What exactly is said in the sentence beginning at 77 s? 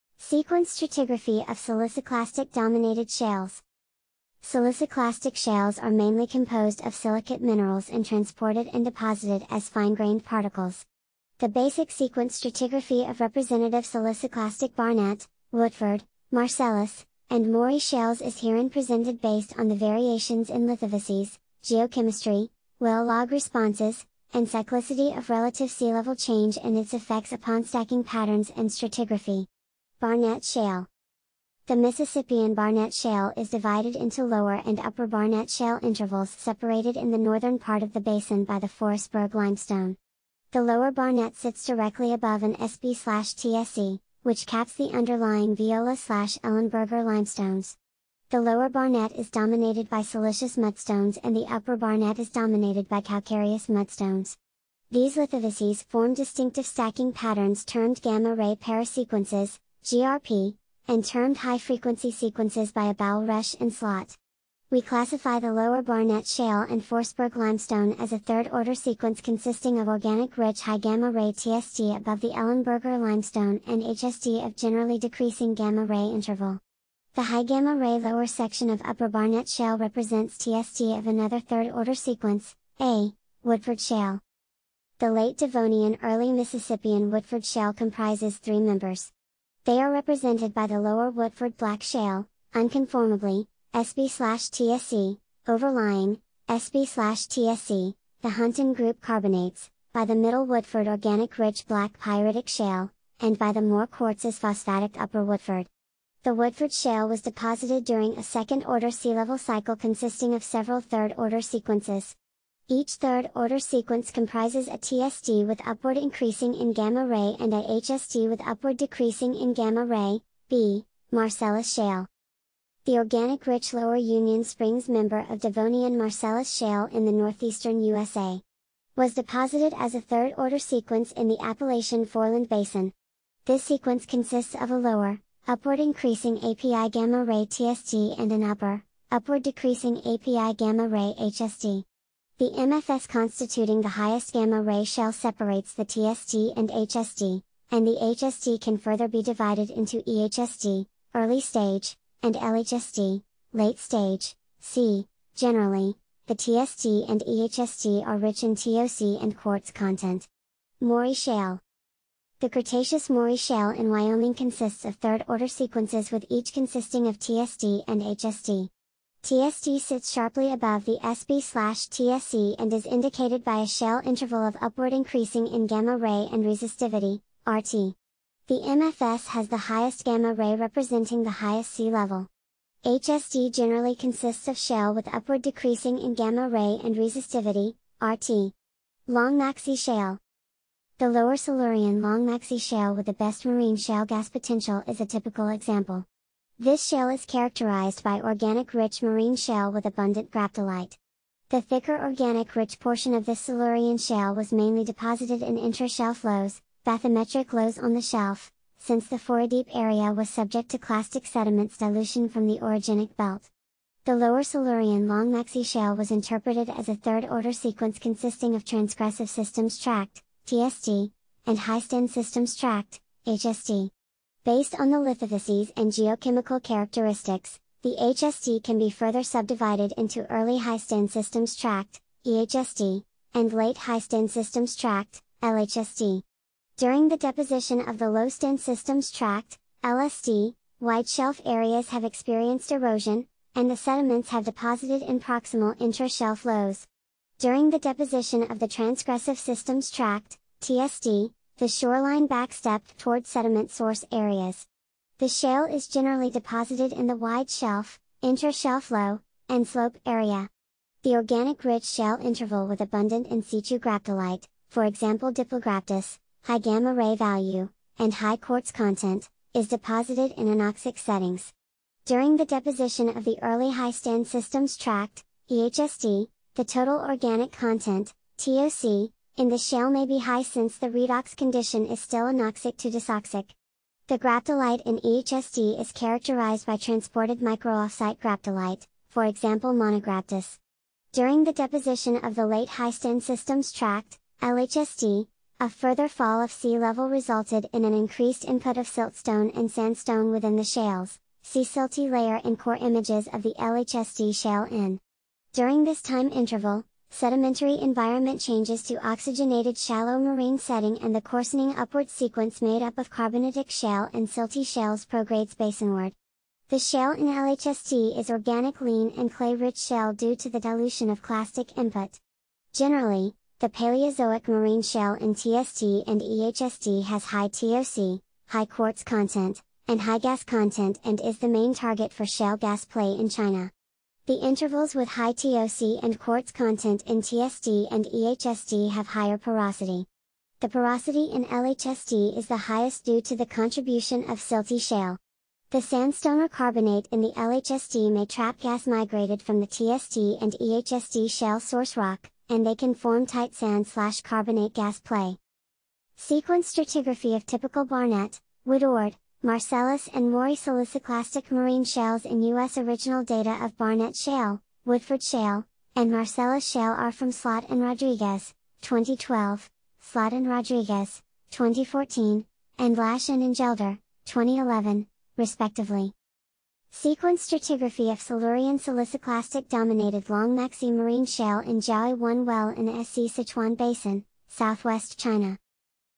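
The high gamma-ray lower section of upper Barnett Shale represents TSD of another third-order sequence, A, Woodford Shale.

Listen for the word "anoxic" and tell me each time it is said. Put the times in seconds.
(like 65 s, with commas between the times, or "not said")
270 s, 282 s.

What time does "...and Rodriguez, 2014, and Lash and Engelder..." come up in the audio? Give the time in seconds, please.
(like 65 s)
370 s.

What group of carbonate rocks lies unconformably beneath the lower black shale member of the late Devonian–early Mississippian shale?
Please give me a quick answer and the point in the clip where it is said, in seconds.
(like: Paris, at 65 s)
Hunton group, at 98 s.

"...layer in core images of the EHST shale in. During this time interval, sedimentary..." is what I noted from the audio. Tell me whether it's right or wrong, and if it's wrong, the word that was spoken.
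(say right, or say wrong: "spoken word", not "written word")
wrong: "LHSD", not "EHST".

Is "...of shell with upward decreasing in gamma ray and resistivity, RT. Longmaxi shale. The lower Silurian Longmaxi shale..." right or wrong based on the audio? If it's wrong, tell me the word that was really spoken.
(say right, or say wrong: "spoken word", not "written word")
right.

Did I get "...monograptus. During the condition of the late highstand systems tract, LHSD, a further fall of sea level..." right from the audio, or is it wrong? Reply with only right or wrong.
wrong.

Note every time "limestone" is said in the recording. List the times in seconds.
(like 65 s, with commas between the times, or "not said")
39 s, 47 s, 67 s, 73 s.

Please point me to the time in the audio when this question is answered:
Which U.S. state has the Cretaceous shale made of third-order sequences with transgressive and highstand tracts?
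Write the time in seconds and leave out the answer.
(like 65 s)
163 s.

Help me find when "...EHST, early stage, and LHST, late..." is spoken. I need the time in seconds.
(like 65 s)
150 s.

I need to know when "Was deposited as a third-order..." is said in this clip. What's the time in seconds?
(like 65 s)
128 s.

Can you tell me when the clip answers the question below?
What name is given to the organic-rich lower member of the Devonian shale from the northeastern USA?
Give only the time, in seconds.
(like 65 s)
123 s.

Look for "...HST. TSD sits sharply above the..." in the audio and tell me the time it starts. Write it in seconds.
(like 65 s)
168 s.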